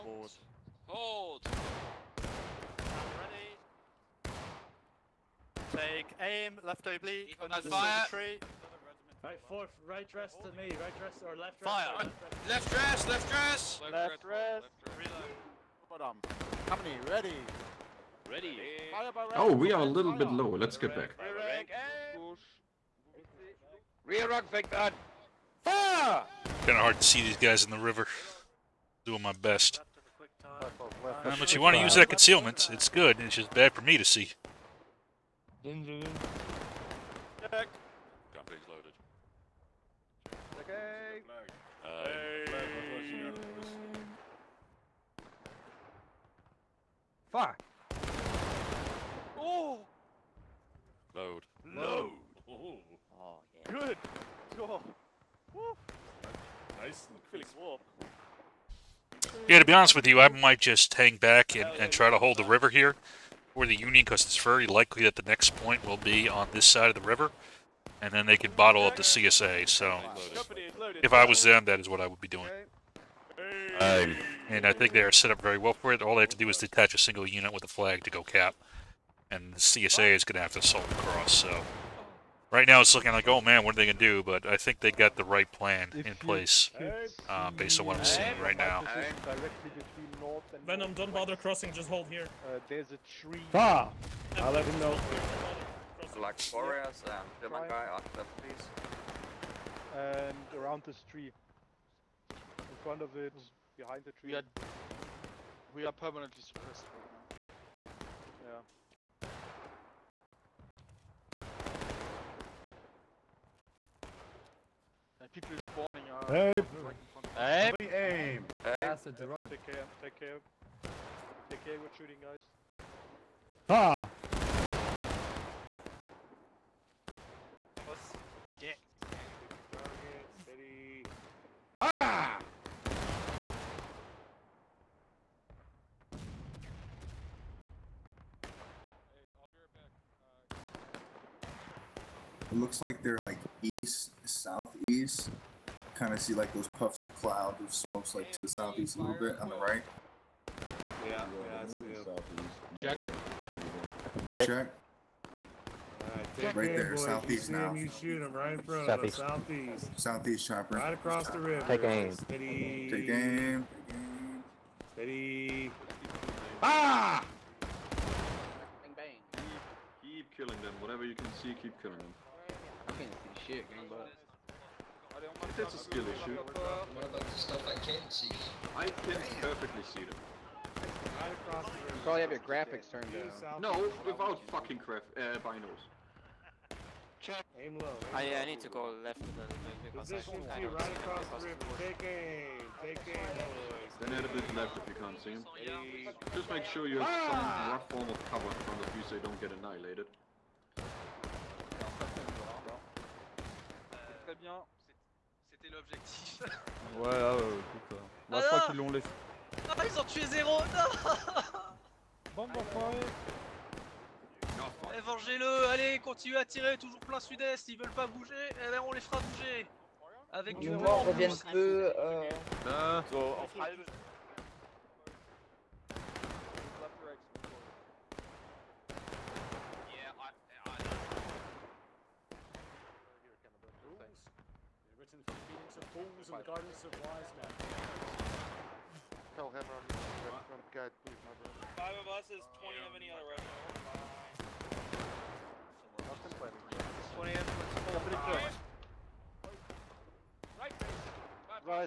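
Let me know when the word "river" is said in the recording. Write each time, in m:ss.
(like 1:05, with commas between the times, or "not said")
0:27, 1:02, 1:07, 2:41, 3:11.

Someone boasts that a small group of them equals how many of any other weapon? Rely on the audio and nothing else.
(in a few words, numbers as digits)
20.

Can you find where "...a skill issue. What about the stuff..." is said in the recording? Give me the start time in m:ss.
2:55.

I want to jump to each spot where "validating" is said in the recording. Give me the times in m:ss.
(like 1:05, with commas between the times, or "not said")
not said.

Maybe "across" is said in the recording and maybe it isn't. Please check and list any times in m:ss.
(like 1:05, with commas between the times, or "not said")
1:20, 2:40, 3:10.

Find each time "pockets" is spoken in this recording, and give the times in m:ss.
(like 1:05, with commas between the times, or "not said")
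not said.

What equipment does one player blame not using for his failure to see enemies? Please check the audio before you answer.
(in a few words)
binos.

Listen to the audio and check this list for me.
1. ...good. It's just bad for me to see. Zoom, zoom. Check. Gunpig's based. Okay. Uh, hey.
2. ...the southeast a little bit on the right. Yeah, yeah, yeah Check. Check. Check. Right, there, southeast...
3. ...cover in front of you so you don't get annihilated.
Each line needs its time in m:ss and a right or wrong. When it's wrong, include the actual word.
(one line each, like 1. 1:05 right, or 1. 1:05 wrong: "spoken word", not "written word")
1. 0:32 wrong: "loaded", not "based"
2. 2:28 right
3. 3:18 right.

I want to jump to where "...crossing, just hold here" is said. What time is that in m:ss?
1:31.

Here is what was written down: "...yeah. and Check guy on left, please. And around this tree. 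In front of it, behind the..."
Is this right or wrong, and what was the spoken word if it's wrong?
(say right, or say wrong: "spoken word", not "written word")
wrong: "German", not "Check".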